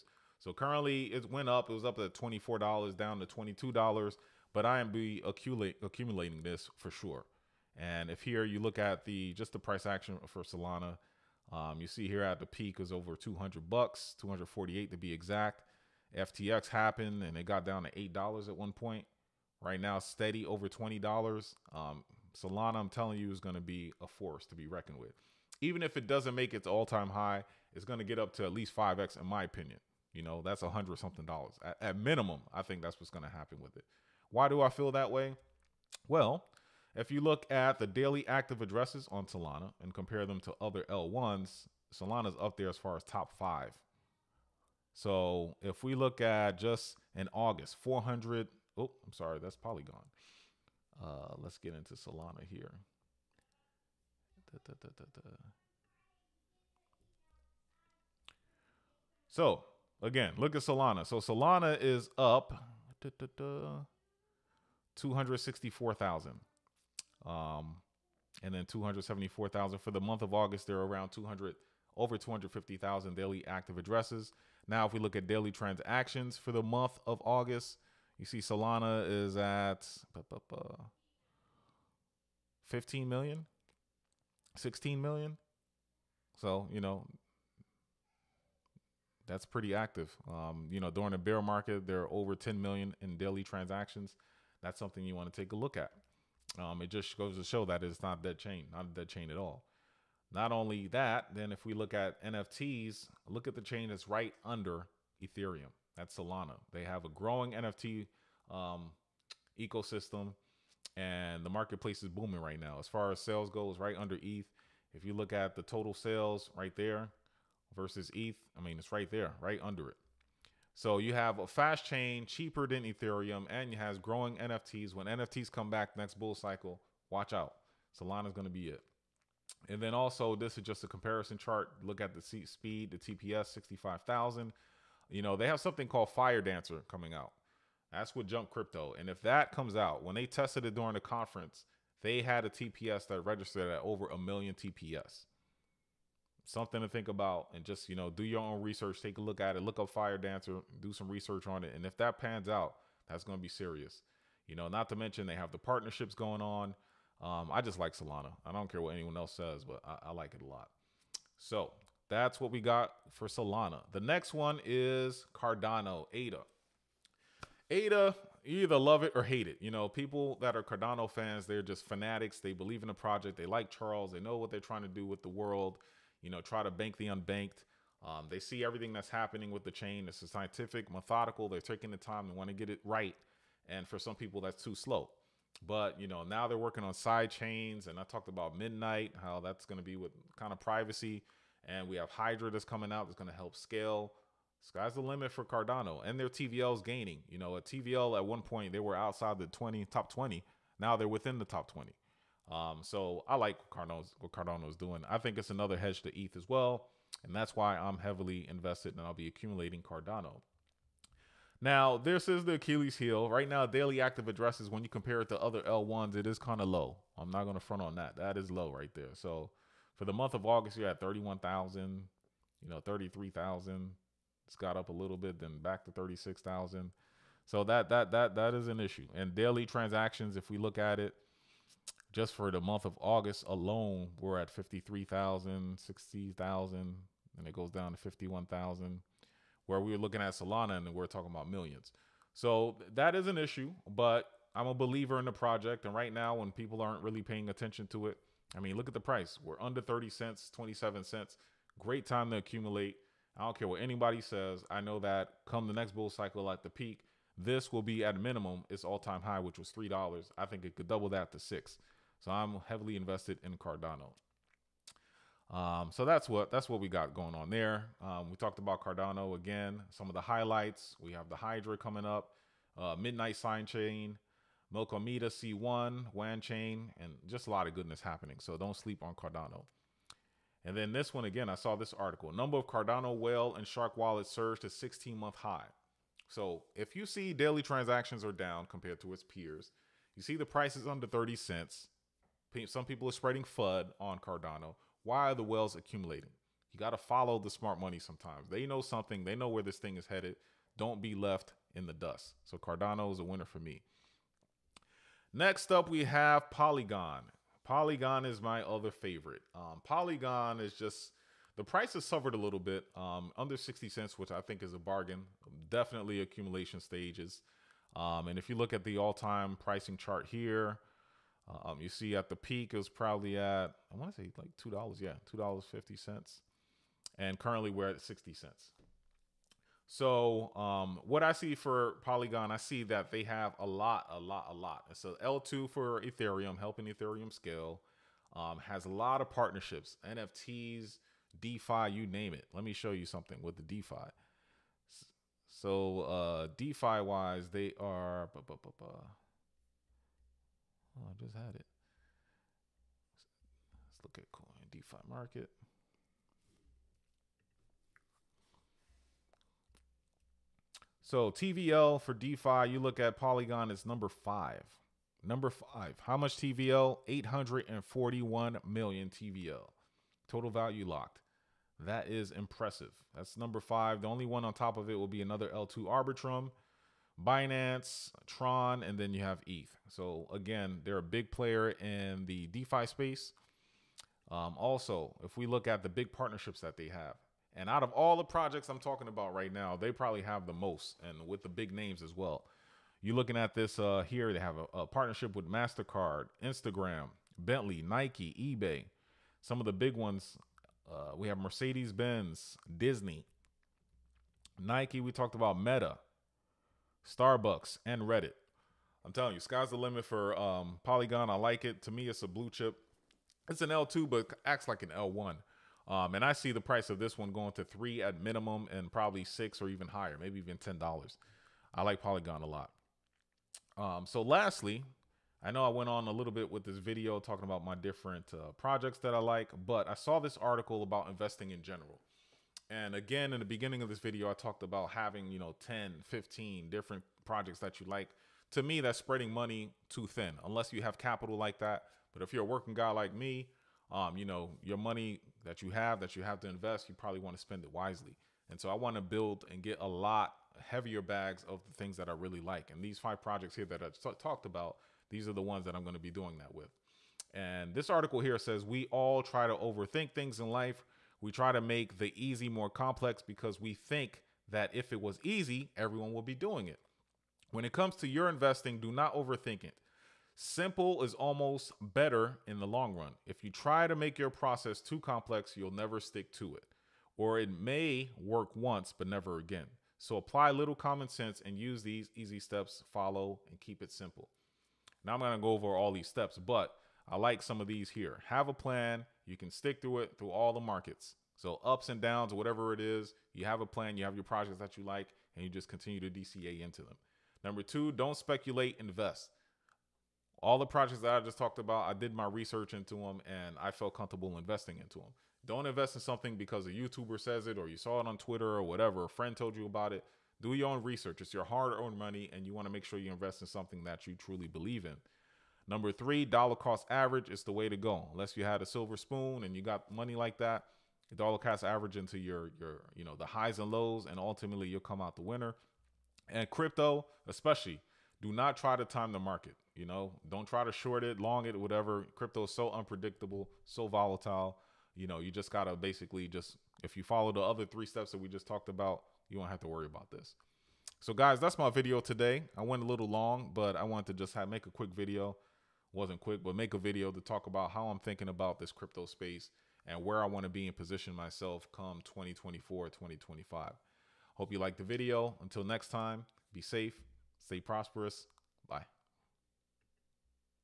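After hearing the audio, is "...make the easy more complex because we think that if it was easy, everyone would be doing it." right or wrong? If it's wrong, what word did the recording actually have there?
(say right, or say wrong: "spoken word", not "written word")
right.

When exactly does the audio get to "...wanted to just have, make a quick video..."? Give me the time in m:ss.
9:03.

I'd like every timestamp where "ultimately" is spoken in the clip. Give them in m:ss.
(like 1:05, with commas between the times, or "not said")
8:44.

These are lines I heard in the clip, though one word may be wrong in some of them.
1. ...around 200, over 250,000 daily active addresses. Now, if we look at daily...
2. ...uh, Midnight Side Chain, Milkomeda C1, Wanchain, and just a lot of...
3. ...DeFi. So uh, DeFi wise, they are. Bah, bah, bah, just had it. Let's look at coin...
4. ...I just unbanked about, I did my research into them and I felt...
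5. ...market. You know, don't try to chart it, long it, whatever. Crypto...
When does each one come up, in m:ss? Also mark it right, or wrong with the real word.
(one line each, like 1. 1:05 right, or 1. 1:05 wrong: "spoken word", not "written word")
1. 1:10 right
2. 4:32 right
3. 5:43 right
4. 8:21 wrong: "talked", not "unbanked"
5. 8:49 wrong: "short", not "chart".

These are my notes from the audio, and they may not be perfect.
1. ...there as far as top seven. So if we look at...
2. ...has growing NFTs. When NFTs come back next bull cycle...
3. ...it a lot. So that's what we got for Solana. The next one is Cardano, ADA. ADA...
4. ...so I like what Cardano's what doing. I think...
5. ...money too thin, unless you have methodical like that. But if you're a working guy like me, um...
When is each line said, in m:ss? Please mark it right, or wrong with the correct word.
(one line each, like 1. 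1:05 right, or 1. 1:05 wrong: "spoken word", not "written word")
1. 0:42 wrong: "five", not "seven"
2. 2:03 right
3. 2:40 right
4. 3:22 right
5. 7:19 wrong: "capital", not "methodical".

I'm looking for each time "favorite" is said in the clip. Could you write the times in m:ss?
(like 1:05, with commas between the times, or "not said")
5:08.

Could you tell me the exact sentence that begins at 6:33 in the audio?
You're looking at this uh, here.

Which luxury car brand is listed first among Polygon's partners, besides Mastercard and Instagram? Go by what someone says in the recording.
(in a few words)
Bentley.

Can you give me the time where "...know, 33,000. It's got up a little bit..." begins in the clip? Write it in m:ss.
3:42.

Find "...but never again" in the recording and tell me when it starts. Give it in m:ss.
7:58.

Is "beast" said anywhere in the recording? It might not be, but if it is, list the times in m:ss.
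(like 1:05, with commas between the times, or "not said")
not said.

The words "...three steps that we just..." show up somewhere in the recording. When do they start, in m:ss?
8:57.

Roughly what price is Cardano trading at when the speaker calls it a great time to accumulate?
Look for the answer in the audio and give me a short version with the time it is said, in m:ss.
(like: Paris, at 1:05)
27 cents, at 4:10.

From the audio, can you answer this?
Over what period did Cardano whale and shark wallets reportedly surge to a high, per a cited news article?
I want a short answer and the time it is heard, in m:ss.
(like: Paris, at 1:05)
16 months, at 4:44.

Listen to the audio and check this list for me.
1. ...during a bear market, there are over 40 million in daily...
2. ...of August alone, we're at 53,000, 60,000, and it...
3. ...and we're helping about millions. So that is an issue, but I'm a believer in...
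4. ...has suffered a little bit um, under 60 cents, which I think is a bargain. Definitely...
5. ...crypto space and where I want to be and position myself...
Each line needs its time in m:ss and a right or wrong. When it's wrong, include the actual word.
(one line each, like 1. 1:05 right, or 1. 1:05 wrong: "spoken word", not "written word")
1. 1:30 wrong: "10", not "40"
2. 3:52 right
3. 4:00 wrong: "talking", not "helping"
4. 5:11 right
5. 9:08 right.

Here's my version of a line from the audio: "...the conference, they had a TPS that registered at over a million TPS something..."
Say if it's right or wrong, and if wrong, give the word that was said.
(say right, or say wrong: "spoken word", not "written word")
right.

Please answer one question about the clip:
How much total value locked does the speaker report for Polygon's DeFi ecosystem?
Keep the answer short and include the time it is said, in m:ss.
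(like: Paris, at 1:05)
841 million, at 6:07.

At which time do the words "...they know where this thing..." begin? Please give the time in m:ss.
4:59.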